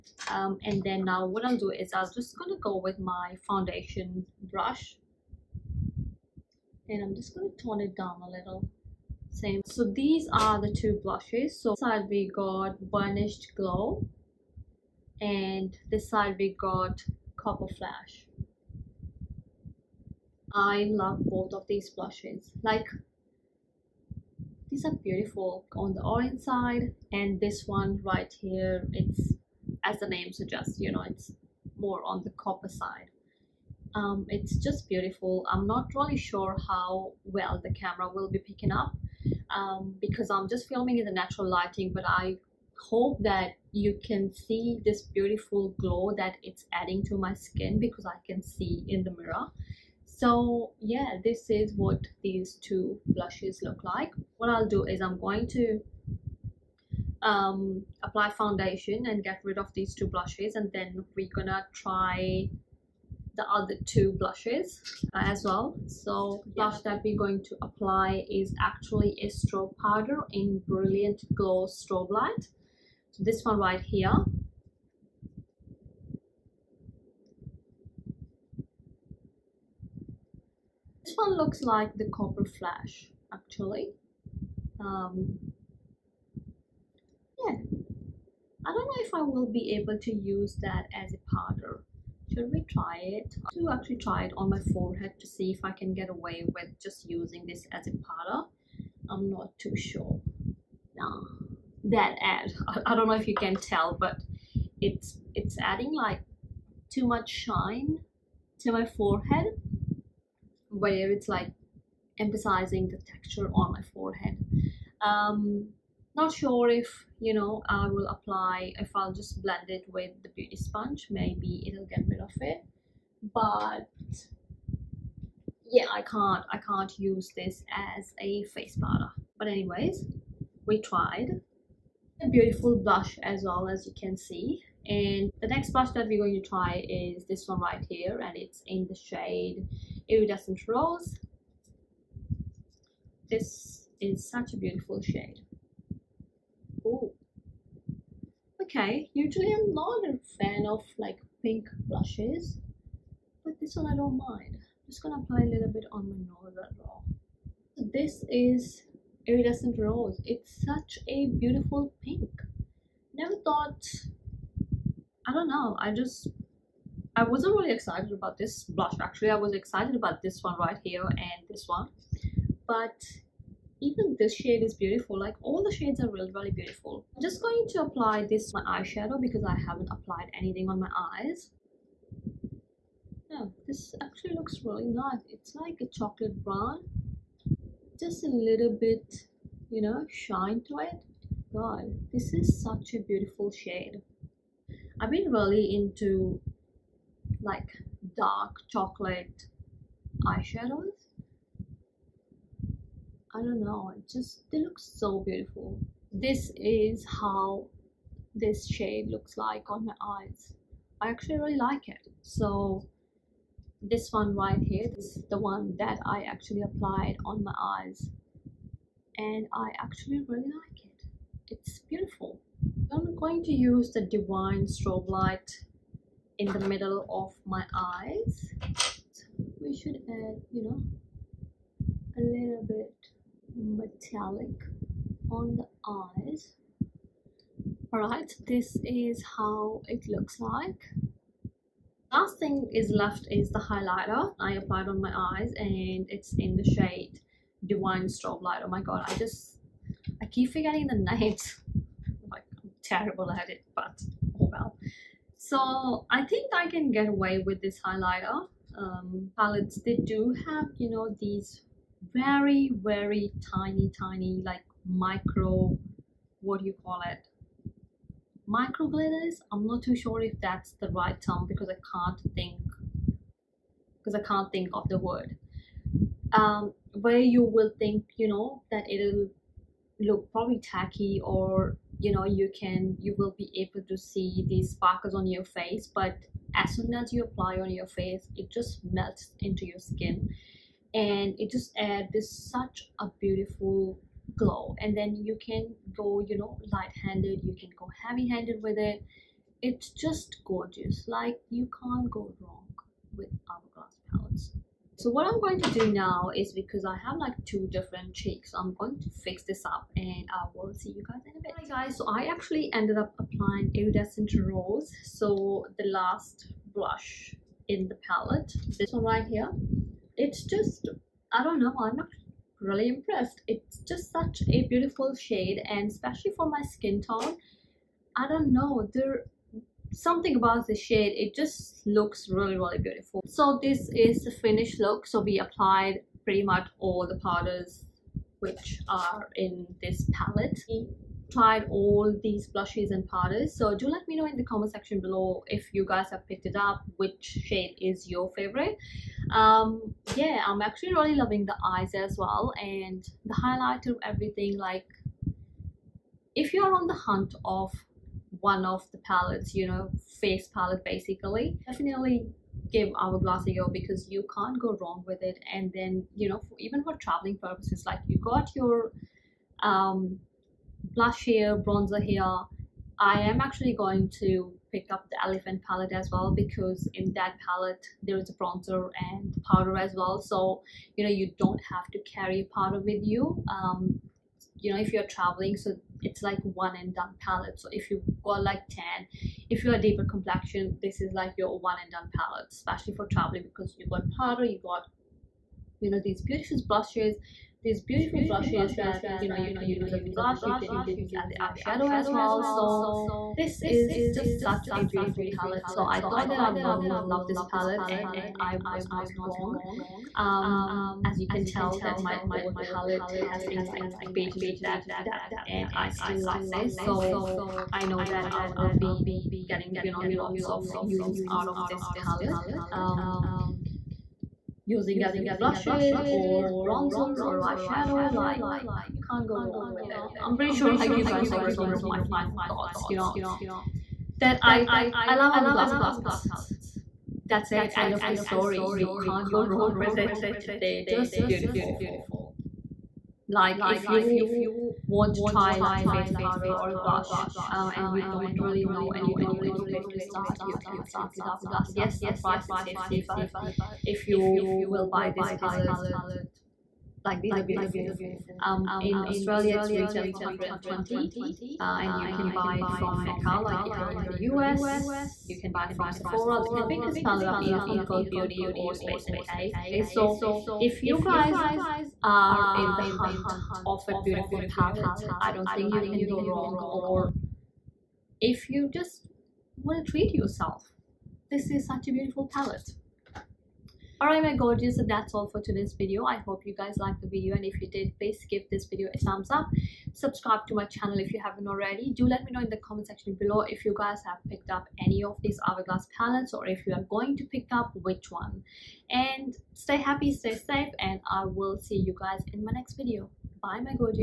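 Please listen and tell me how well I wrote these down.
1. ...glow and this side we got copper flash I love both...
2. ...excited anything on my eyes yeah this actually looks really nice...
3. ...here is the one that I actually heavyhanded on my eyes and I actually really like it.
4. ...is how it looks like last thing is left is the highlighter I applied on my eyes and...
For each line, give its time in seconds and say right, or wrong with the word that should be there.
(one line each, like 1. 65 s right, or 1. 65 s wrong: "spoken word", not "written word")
1. 13 s right
2. 179 s wrong: "applied", not "excited"
3. 214 s wrong: "applied", not "heavyhanded"
4. 238 s right.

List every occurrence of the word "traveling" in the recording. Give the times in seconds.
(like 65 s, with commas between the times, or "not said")
367 s, 385 s, 393 s.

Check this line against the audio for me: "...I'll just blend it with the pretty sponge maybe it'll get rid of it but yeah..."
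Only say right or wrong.
wrong.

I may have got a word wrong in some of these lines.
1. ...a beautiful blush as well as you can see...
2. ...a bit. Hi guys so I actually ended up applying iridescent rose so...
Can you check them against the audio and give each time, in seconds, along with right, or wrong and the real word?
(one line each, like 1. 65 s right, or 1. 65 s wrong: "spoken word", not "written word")
1. 132 s right
2. 311 s right.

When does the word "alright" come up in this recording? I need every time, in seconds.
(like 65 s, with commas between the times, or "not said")
237 s, 484 s.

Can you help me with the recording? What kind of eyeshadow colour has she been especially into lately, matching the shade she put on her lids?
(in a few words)
Dark chocolate.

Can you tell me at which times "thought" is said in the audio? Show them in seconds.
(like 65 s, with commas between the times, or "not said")
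163 s, 406 s, 432 s.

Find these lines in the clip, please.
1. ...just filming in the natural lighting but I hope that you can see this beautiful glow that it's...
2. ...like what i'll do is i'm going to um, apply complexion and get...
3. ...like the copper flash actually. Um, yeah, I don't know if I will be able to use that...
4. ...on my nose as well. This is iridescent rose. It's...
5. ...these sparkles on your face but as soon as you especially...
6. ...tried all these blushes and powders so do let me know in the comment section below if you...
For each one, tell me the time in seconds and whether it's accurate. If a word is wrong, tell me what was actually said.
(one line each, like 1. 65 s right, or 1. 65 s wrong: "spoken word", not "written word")
1. 40 s right
2. 53 s wrong: "foundation", not "complexion"
3. 81 s right
4. 155 s right
5. 284 s wrong: "apply", not "especially"
6. 341 s right.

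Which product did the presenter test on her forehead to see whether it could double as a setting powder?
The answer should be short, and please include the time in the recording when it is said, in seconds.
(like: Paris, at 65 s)
Brilliant Glow Strobe Light, at 70 s.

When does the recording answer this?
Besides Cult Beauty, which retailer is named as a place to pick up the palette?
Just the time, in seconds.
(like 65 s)
468 s.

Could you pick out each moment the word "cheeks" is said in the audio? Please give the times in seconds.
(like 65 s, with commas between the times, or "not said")
308 s.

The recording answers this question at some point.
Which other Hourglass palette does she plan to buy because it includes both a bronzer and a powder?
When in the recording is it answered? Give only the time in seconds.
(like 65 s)
375 s.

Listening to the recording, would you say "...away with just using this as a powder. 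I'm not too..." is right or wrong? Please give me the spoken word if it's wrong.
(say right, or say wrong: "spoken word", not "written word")
right.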